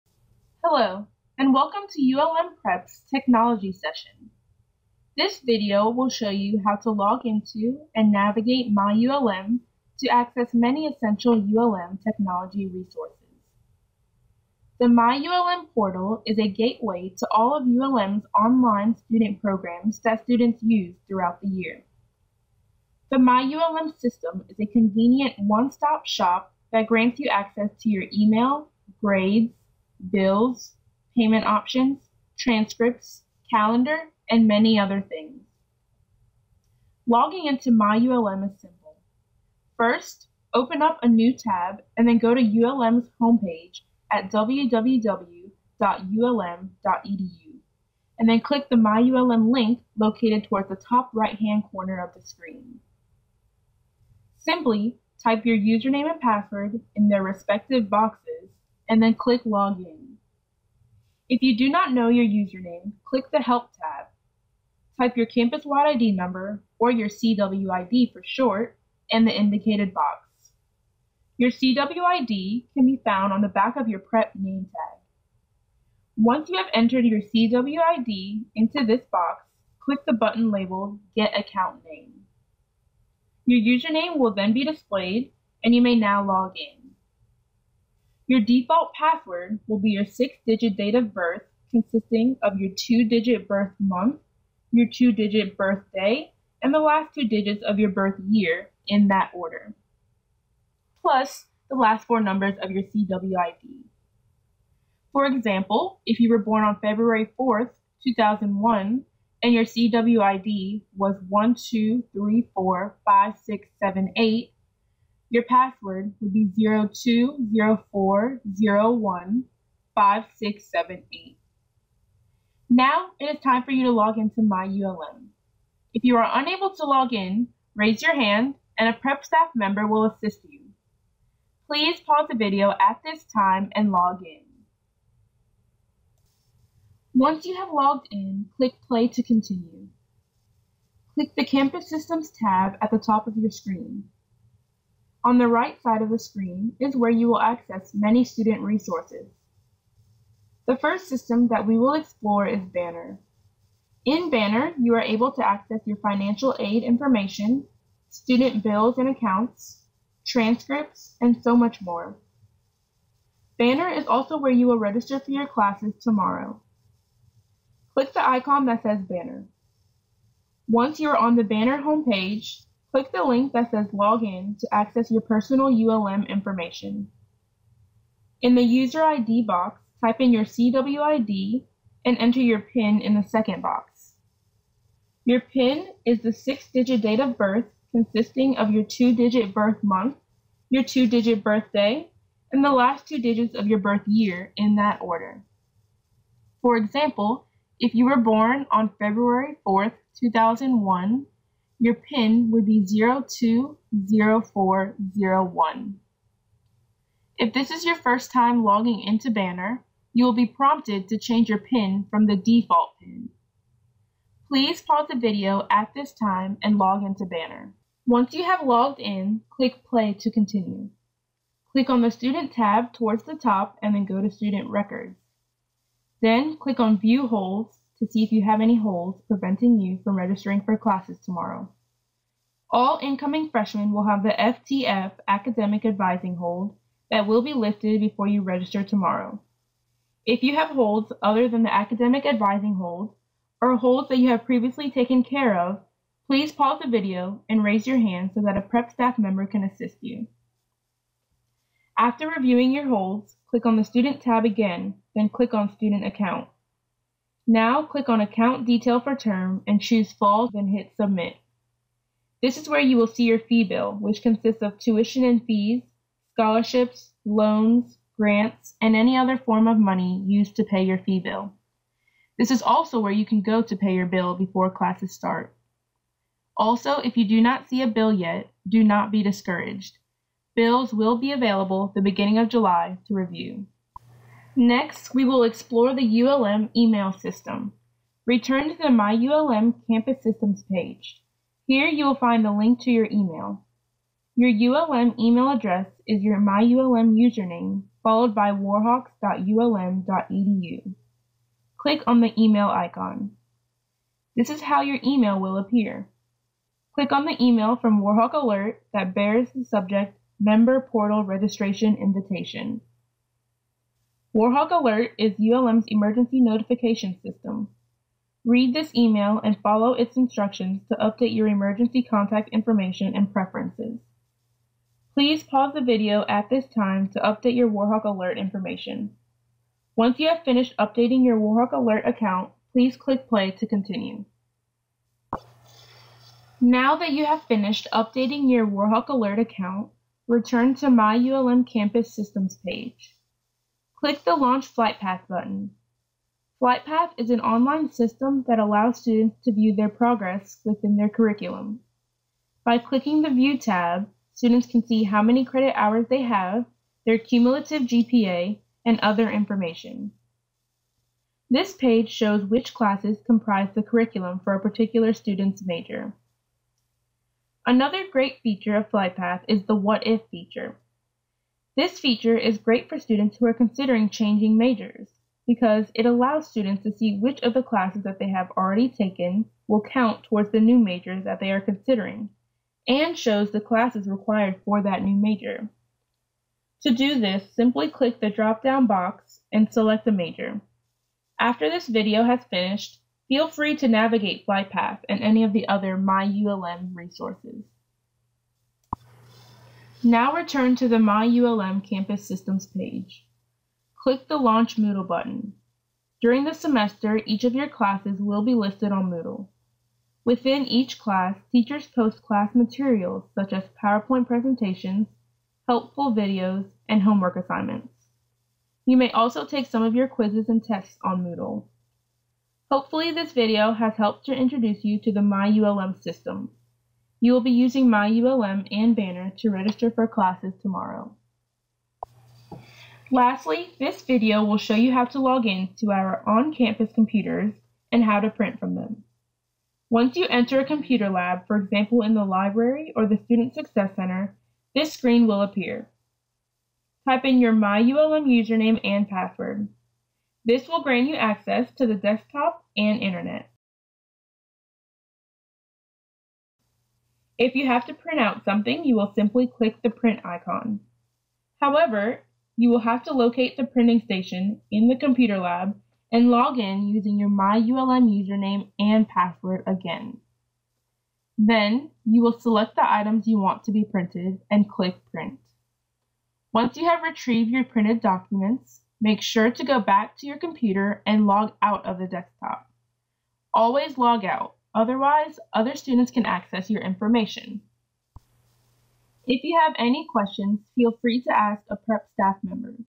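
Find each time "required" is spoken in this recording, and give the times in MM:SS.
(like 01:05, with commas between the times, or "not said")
06:24.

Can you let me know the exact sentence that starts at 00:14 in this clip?
The MyULM portal is a gateway to all of ULM's online student programs that students use throughout the year.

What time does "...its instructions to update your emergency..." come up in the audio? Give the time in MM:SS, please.
05:19.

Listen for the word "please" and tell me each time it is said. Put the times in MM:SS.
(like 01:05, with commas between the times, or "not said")
02:11, 03:34, 04:06, 05:25, 05:32.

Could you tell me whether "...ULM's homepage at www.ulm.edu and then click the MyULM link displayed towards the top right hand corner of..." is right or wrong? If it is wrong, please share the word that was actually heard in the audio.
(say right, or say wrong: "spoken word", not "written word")
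wrong: "located", not "displayed".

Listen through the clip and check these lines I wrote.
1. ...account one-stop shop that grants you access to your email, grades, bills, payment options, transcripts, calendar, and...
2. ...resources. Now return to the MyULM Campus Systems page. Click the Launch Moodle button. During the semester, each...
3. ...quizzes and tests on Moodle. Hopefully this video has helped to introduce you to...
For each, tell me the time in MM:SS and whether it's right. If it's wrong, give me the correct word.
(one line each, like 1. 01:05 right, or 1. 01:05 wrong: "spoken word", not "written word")
1. 00:24 wrong: "convenient", not "account"
2. 06:36 right
3. 07:00 right.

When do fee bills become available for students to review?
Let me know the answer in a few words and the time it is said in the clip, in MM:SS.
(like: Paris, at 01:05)
beginning of July, at 04:42.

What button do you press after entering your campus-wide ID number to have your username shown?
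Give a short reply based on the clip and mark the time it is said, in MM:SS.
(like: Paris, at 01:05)
Get Account Name, at 01:21.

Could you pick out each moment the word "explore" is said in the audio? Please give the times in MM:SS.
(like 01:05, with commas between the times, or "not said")
02:31, 04:45.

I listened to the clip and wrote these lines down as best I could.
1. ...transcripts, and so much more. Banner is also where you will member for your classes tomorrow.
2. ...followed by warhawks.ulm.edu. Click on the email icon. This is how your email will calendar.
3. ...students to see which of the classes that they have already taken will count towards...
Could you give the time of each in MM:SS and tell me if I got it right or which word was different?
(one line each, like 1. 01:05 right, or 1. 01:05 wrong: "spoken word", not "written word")
1. 02:40 wrong: "register", not "member"
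2. 04:58 wrong: "appear", not "calendar"
3. 06:16 right.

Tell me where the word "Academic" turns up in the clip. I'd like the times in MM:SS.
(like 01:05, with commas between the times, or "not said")
03:55, 04:01.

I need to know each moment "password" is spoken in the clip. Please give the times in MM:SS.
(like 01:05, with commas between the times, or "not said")
00:56, 01:28, 01:55, 07:29, 07:49.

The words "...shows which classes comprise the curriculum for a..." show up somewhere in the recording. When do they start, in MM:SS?
06:02.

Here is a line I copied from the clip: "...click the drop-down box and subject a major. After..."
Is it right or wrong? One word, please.
wrong.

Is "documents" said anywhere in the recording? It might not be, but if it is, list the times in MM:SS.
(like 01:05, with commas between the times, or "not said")
07:58.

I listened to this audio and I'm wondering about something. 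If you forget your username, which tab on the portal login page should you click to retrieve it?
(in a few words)
Help.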